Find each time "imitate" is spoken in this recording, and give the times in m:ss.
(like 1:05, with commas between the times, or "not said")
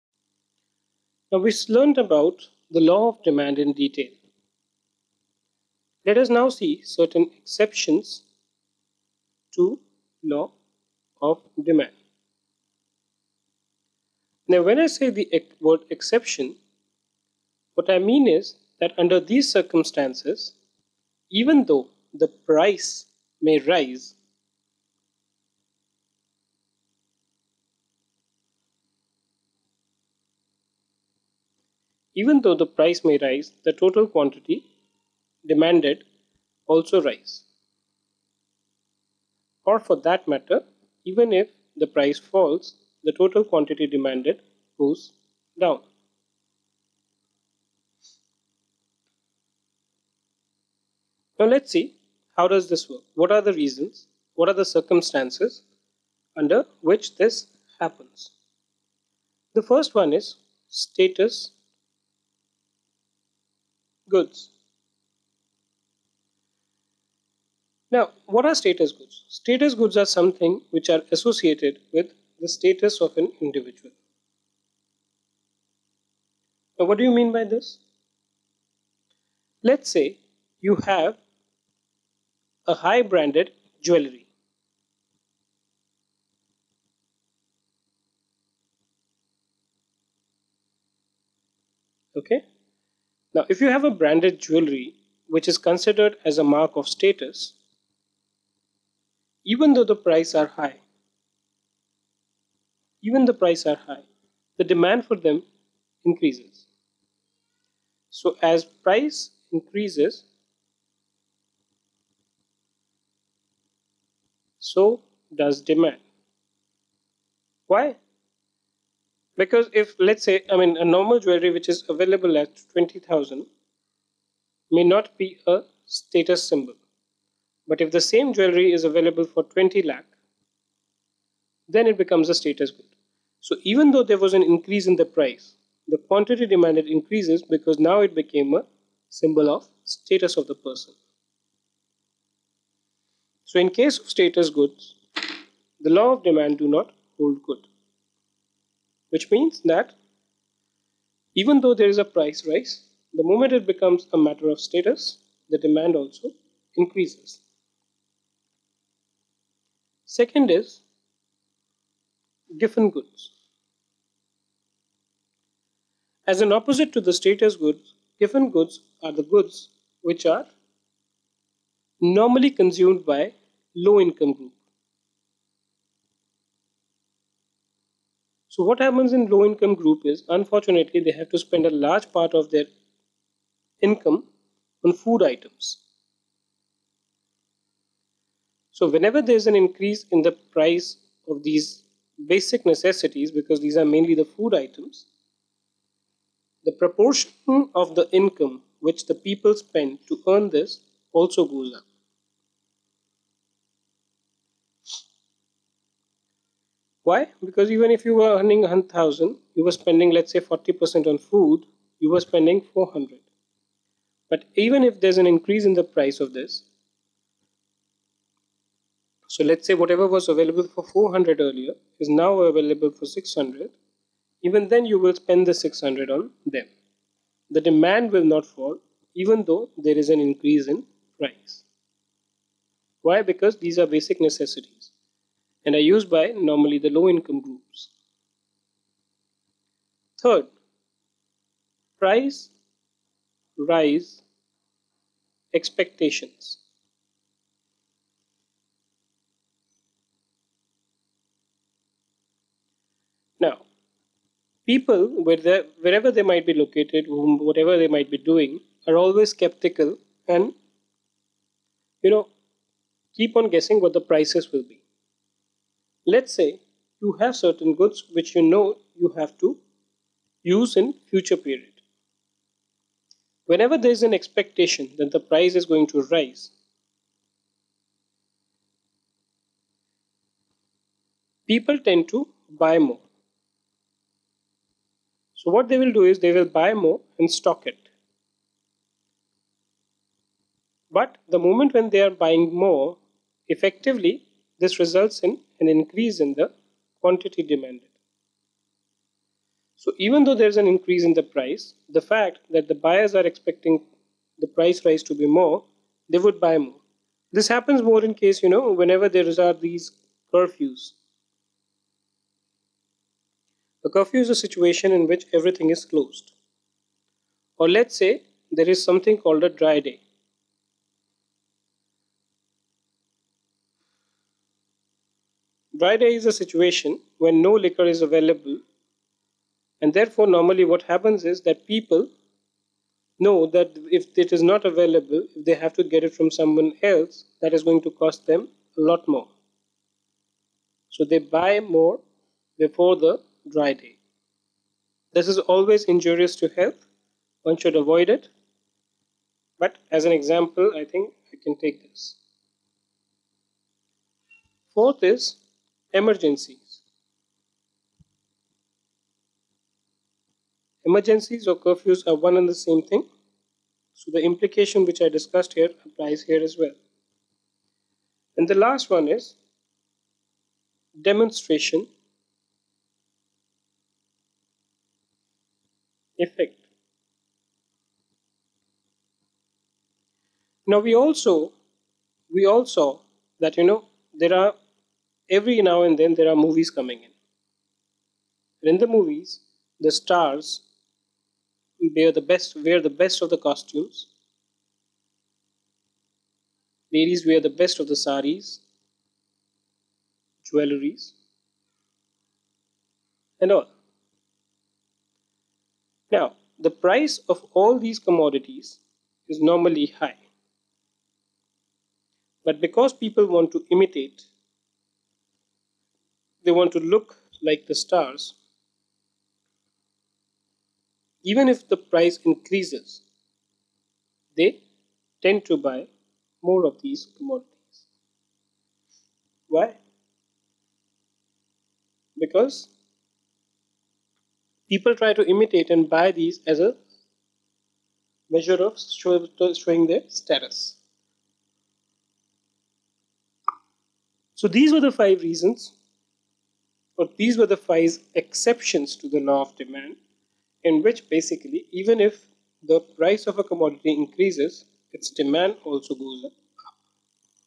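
6:53, 7:15.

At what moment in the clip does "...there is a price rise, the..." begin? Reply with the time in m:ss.
2:31.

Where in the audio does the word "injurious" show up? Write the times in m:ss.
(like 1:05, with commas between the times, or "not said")
5:45.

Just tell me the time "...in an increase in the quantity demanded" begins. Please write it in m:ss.
4:55.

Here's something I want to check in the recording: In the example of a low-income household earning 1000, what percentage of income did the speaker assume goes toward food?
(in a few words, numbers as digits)
40%.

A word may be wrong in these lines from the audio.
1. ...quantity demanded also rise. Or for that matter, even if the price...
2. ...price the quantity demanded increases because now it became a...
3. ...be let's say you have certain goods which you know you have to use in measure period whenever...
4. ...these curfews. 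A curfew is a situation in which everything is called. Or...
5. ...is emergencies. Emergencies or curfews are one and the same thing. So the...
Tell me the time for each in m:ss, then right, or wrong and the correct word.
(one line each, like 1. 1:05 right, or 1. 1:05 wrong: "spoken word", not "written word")
1. 0:34 right
2. 2:15 right
3. 4:24 wrong: "future", not "measure"
4. 5:09 wrong: "closed", not "called"
5. 5:55 right.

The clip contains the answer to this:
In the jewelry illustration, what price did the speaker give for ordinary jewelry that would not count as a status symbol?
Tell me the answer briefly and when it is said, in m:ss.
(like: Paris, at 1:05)
20000, at 2:02.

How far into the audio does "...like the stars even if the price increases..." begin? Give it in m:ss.
6:57.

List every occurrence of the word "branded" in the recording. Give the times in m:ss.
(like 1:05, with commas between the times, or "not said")
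1:23, 1:33.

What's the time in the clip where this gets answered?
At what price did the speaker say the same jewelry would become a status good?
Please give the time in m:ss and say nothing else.
2:09.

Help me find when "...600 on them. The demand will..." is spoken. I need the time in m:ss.
3:45.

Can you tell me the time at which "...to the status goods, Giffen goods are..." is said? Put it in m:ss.
2:46.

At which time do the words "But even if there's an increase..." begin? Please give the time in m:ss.
3:34.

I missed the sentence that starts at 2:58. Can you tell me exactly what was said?
So what happens in low income group is unfortunately they have to spend a large part of their income on food items.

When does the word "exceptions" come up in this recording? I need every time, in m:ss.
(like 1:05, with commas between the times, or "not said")
0:07, 0:15, 7:28.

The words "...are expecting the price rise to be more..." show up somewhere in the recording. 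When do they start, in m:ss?
5:03.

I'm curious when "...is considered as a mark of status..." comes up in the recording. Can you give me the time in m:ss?
1:35.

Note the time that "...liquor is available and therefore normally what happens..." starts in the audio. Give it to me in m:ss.
5:27.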